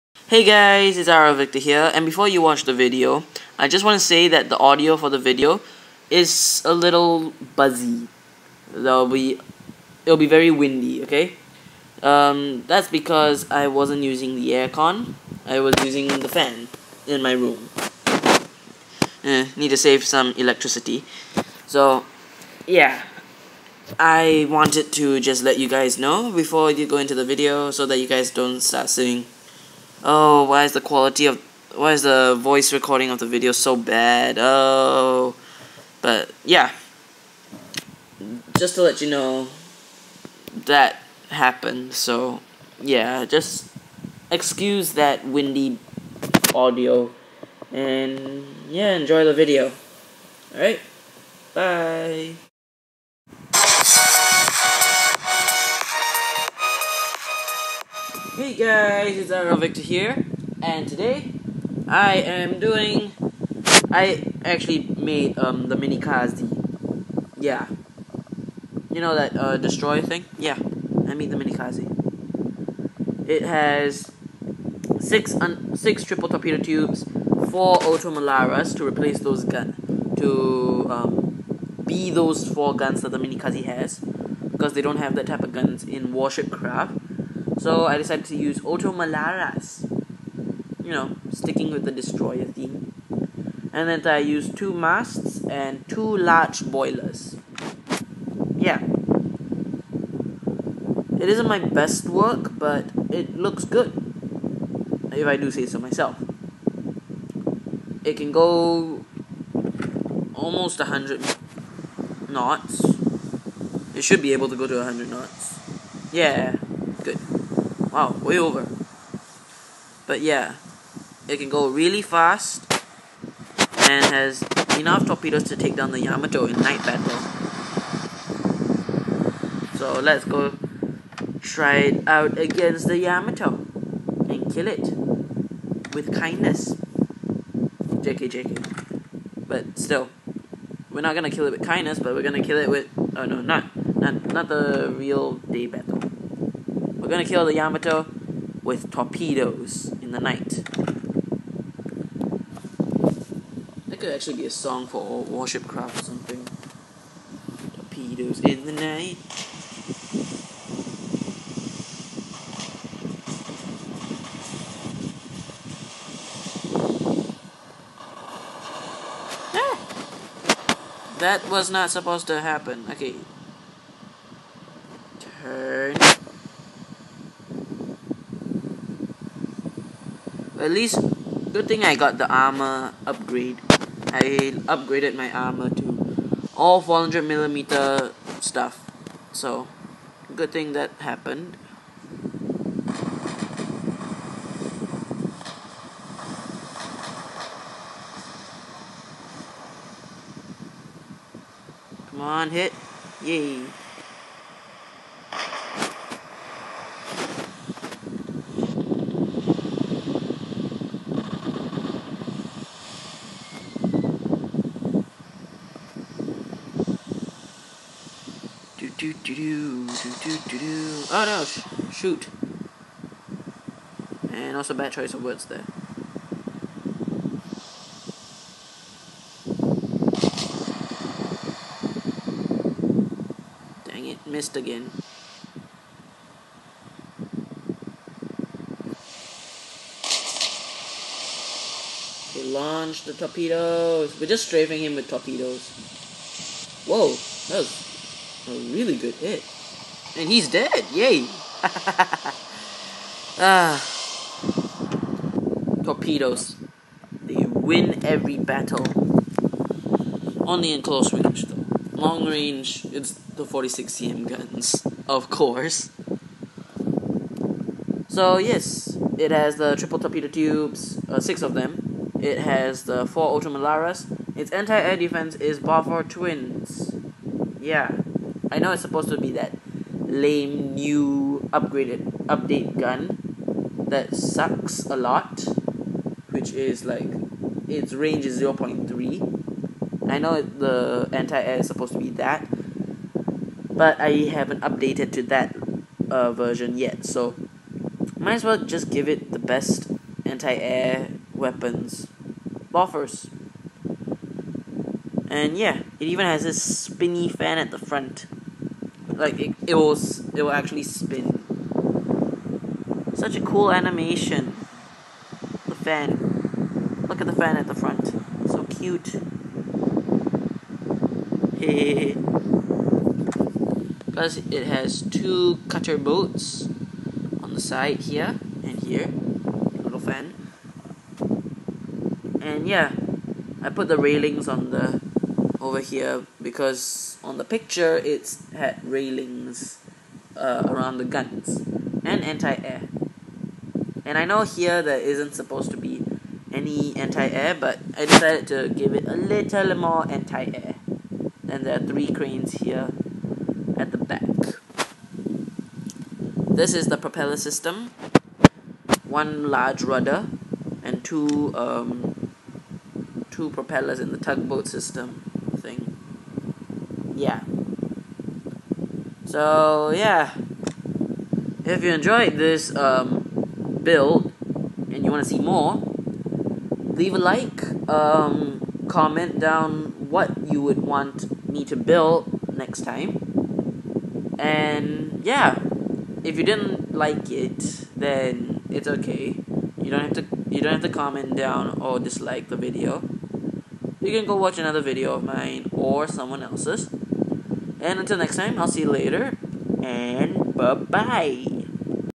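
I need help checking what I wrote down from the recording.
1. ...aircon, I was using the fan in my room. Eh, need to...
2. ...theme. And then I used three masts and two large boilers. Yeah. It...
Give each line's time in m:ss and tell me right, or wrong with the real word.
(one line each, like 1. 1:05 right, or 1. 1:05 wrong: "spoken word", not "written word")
1. 0:14 right
2. 1:32 wrong: "two", not "three".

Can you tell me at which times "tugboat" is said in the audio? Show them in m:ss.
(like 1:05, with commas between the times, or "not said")
6:04.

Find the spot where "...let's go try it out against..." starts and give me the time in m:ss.
2:09.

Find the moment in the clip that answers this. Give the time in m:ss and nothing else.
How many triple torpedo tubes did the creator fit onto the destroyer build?
1:15.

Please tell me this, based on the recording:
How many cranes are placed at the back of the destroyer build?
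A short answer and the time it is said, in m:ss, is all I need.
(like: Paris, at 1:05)
3, at 5:51.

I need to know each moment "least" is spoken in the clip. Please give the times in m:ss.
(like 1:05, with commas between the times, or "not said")
3:00.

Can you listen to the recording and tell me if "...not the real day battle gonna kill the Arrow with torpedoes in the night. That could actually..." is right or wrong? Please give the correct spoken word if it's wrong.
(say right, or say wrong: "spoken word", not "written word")
wrong: "Yamato", not "Arrow".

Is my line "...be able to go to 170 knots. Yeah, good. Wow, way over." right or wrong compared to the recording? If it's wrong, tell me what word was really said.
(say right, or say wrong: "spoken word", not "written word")
wrong: "100", not "170".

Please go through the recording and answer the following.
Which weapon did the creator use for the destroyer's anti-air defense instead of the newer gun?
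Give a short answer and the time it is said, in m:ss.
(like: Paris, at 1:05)
Bofors Twins, at 4:35.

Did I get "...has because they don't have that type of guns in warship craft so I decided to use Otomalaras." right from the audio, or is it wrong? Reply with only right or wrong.
right.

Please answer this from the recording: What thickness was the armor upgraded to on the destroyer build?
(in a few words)
400 millimeter.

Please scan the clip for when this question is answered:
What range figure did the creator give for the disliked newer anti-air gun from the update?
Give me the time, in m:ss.
4:48.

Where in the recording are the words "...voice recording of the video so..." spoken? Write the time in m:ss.
0:32.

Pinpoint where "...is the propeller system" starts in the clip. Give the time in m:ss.
5:56.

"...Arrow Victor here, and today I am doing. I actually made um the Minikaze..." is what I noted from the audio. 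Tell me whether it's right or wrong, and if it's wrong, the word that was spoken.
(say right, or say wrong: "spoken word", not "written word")
right.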